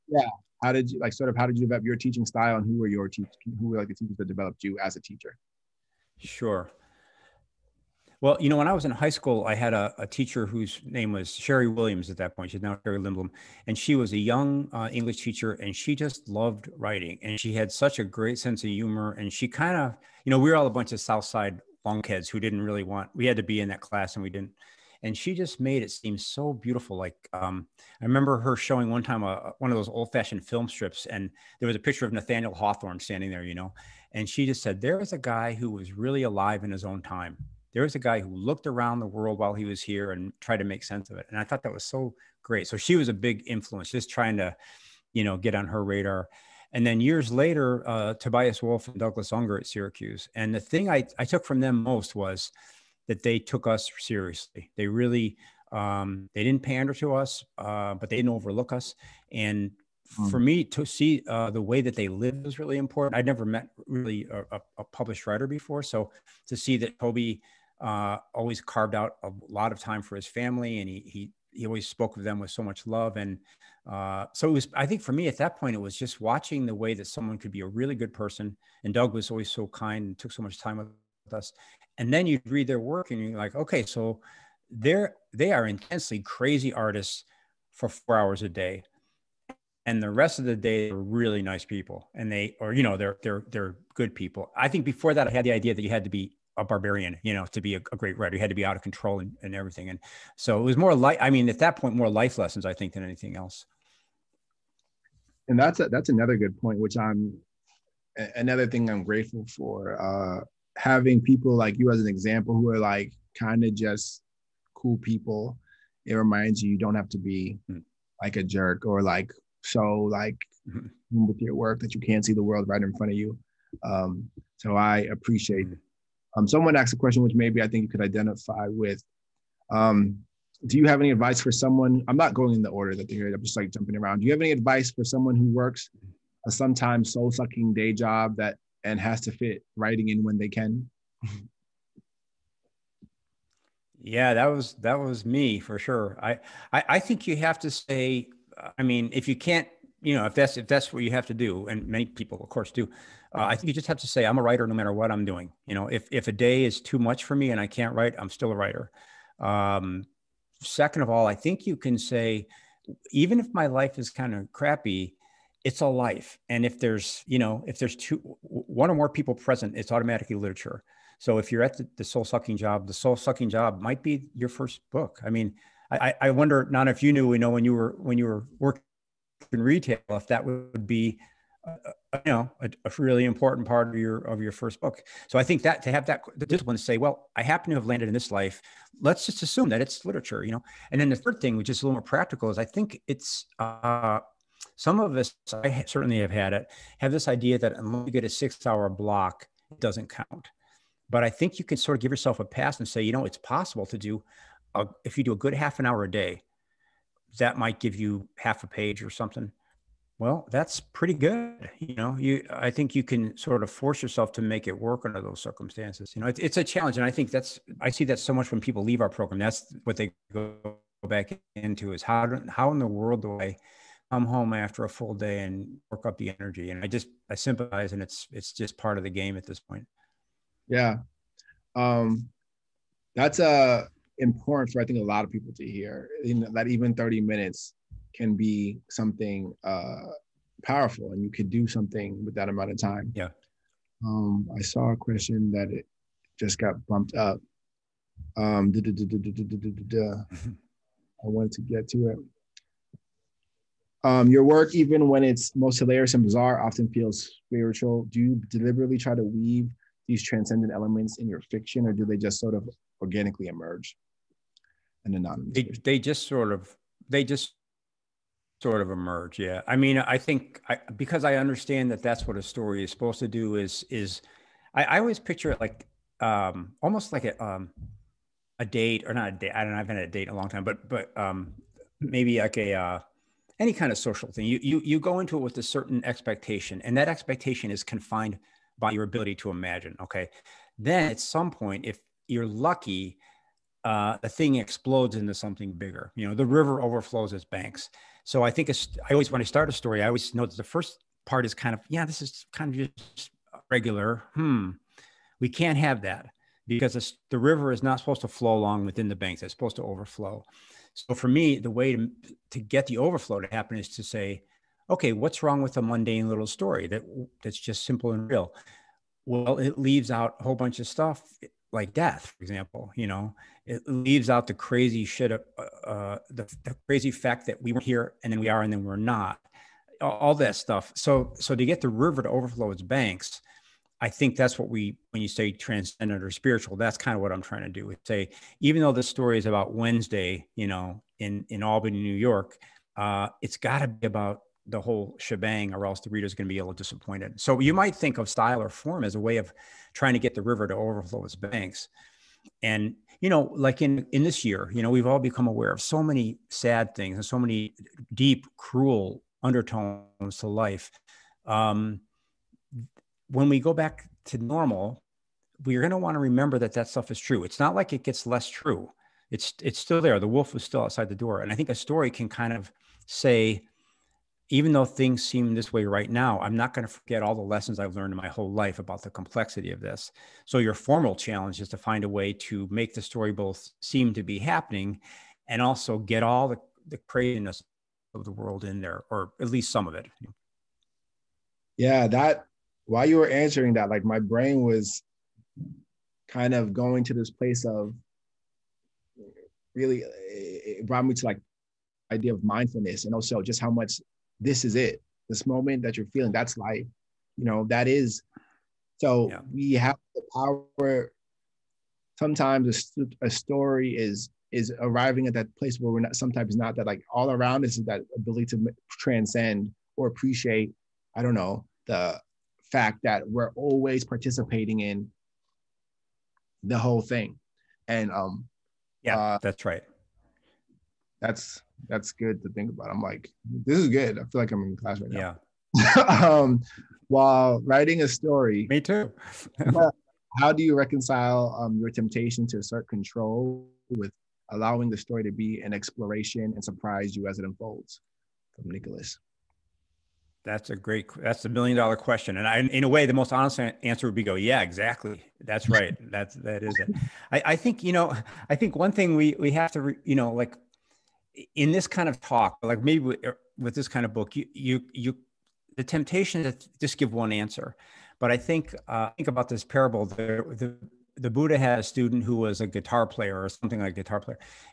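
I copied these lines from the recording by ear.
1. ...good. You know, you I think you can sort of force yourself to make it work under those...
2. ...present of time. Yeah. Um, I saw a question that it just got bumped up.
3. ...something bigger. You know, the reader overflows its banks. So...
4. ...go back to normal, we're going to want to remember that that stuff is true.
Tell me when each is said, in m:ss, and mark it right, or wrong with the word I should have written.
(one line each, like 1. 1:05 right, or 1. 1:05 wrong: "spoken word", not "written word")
1. 3:31 right
2. 4:02 wrong: "amount", not "present"
3. 4:55 wrong: "river", not "reader"
4. 6:03 right.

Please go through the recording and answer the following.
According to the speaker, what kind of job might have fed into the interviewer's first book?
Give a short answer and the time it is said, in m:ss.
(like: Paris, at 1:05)
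retail, at 2:59.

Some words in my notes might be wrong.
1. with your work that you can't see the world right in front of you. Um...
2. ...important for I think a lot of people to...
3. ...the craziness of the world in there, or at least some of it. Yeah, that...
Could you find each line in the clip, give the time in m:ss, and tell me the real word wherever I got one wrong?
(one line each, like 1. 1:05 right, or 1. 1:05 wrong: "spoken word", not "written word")
1. 2:01 right
2. 3:54 right
3. 6:26 right.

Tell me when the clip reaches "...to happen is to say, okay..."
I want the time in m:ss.
5:13.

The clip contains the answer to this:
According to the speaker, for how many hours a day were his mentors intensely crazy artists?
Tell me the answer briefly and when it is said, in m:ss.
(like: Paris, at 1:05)
4, at 1:27.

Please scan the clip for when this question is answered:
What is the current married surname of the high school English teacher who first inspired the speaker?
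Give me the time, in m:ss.
0:12.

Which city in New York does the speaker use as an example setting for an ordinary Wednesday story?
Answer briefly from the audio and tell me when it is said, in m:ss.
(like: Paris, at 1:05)
Albany, at 5:41.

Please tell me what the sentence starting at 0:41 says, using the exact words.
And I thought that was so great.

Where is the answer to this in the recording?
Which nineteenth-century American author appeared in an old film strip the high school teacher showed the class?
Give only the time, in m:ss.
0:32.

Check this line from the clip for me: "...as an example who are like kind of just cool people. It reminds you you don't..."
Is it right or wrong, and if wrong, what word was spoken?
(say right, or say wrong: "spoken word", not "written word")
right.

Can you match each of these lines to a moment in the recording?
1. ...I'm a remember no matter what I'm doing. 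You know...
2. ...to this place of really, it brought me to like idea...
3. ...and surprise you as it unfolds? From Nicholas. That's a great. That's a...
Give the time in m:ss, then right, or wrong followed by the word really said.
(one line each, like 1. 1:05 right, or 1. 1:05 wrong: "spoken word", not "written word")
1. 2:34 wrong: "writer", not "remember"
2. 6:37 right
3. 7:26 right.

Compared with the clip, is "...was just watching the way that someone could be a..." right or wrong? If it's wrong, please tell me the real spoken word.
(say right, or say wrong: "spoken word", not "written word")
right.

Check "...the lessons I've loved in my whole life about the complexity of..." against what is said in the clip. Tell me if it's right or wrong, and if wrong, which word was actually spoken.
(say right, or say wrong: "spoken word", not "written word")
wrong: "learned", not "loved".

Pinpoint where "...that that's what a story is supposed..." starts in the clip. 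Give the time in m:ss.
4:31.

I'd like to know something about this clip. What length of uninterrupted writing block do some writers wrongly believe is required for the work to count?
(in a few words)
6 hours.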